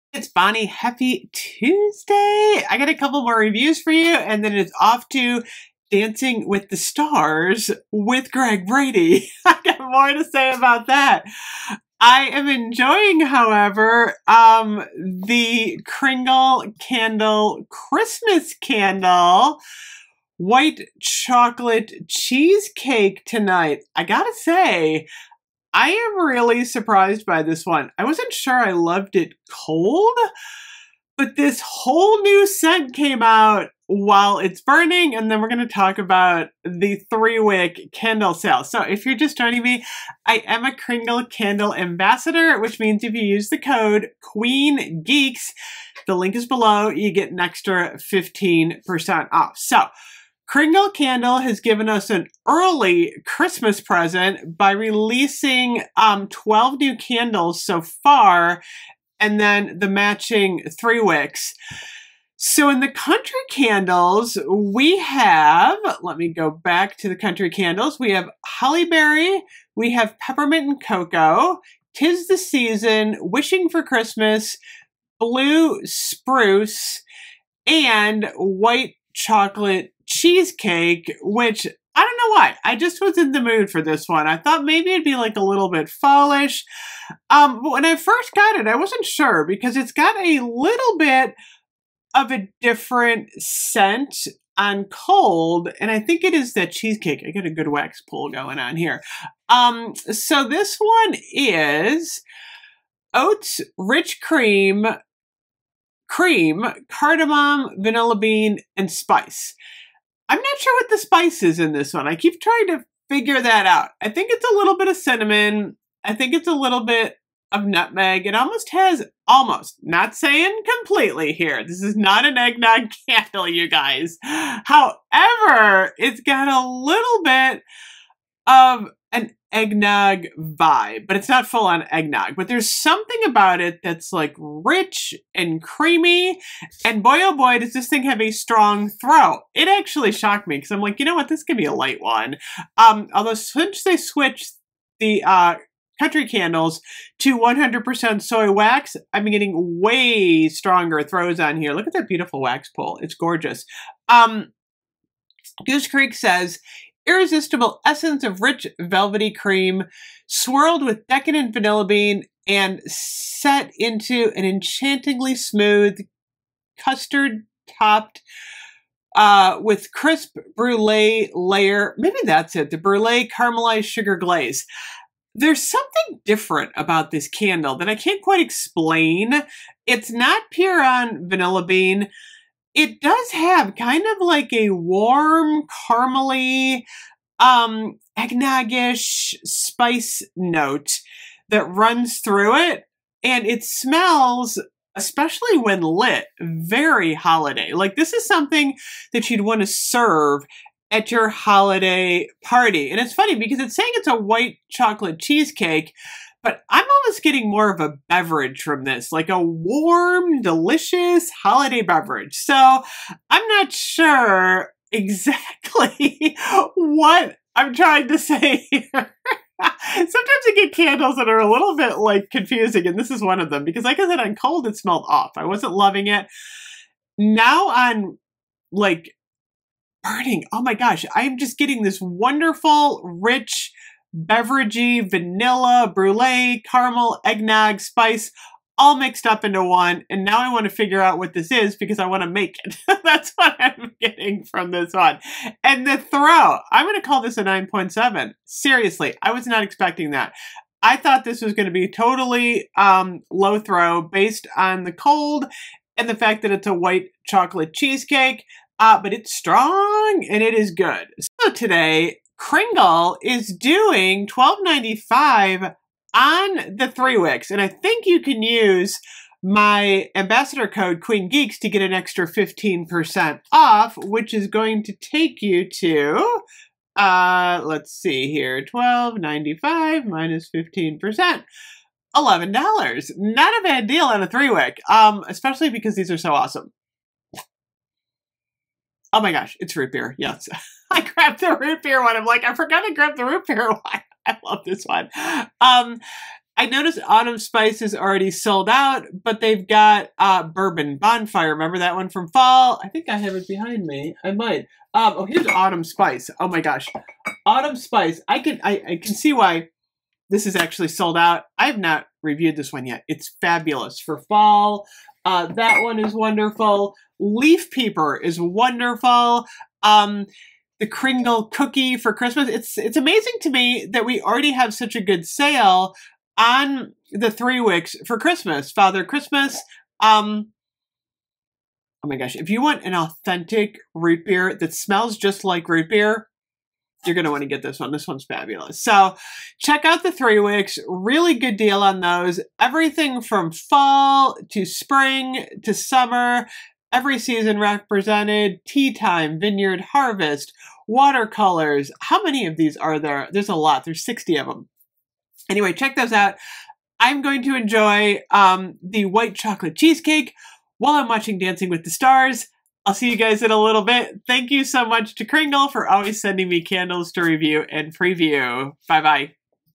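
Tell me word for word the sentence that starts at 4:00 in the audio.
And now I want to figure out what this is because I want to make it.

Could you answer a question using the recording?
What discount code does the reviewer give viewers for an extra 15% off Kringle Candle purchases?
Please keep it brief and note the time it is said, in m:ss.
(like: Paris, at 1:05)
QUEENGEEKS, at 0:44.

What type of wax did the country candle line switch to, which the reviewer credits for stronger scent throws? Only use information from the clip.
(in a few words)
100% soy wax.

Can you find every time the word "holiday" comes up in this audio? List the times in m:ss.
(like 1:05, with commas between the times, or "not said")
3:17, 3:21, 3:31.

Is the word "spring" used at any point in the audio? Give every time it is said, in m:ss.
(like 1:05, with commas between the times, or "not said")
5:44.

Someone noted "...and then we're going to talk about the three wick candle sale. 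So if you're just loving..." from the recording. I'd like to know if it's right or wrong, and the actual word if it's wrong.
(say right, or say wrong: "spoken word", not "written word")
wrong: "joining", not "loving".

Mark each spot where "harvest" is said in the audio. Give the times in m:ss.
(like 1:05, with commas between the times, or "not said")
5:49.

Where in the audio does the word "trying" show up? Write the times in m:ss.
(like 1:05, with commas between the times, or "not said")
1:52, 3:37.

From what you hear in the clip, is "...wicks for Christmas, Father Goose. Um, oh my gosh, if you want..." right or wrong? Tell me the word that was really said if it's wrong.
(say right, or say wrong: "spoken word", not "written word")
wrong: "Christmas", not "Goose".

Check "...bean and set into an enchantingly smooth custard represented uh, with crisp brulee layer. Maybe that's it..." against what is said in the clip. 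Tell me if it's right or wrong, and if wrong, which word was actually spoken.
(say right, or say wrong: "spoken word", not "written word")
wrong: "topped", not "represented".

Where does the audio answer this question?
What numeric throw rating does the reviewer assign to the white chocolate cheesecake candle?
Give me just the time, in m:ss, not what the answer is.
4:07.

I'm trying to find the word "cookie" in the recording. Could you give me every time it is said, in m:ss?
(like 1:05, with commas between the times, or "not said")
5:21.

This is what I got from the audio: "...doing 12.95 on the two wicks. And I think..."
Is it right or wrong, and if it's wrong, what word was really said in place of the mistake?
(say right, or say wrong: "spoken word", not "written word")
wrong: "three", not "two".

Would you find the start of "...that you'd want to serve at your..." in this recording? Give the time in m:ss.
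3:19.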